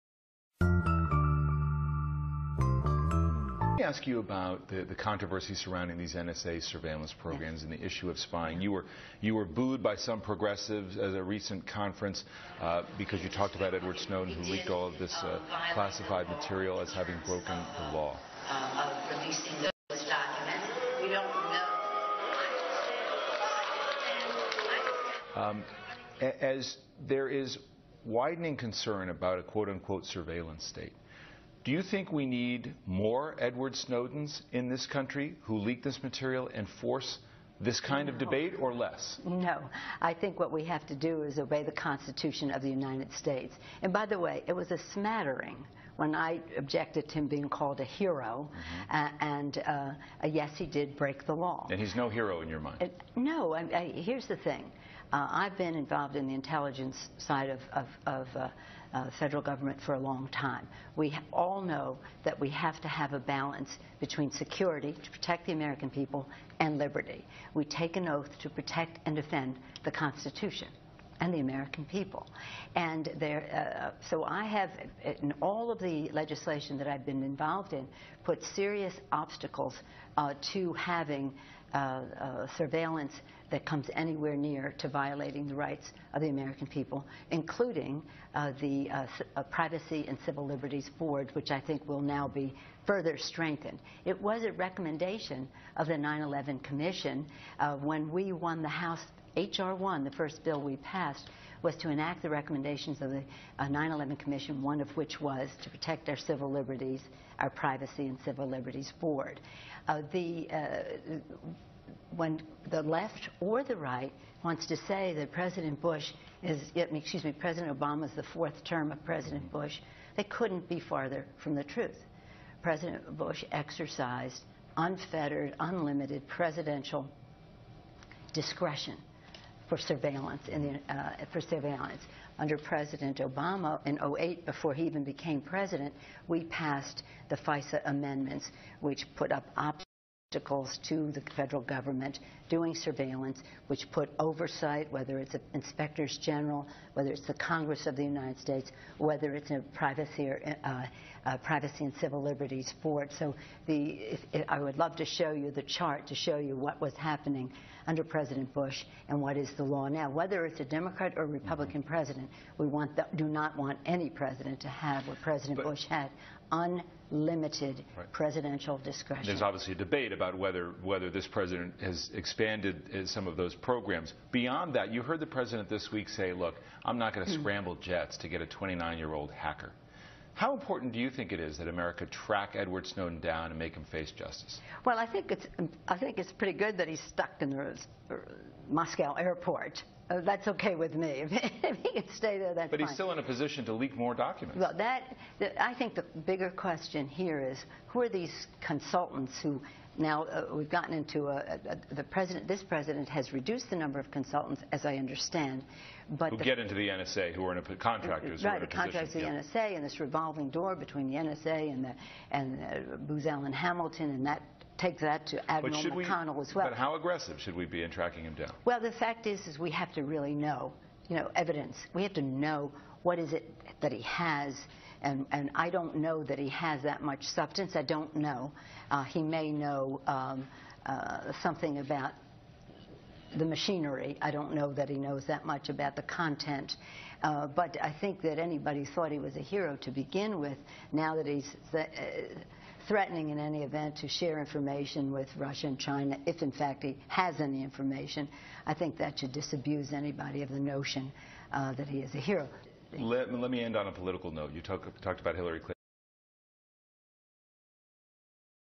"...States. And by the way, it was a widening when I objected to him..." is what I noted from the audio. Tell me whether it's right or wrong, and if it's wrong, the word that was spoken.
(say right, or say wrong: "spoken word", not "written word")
wrong: "smattering", not "widening".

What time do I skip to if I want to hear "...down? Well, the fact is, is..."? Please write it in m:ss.
3:38.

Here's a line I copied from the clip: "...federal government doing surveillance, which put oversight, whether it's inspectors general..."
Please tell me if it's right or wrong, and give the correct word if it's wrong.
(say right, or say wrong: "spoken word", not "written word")
right.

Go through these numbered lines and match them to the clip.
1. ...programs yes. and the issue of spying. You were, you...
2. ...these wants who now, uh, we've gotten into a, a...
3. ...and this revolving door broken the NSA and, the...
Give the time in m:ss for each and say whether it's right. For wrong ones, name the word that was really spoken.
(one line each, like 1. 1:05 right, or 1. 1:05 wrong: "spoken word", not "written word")
1. 0:07 right
2. 3:18 wrong: "consultants", not "wants"
3. 3:29 wrong: "between", not "broken".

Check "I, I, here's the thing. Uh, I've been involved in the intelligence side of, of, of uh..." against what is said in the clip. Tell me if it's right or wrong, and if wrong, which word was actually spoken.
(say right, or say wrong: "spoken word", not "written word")
right.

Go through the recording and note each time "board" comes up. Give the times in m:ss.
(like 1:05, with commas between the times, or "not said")
1:30, 1:48, 2:32.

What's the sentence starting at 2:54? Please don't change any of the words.
Beyond that, you heard the president this week say, look, I'm not going to mm -hmm.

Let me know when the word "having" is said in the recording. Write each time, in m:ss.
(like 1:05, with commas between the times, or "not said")
0:16, 1:20.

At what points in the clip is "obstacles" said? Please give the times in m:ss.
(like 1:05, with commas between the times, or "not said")
1:19, 2:20.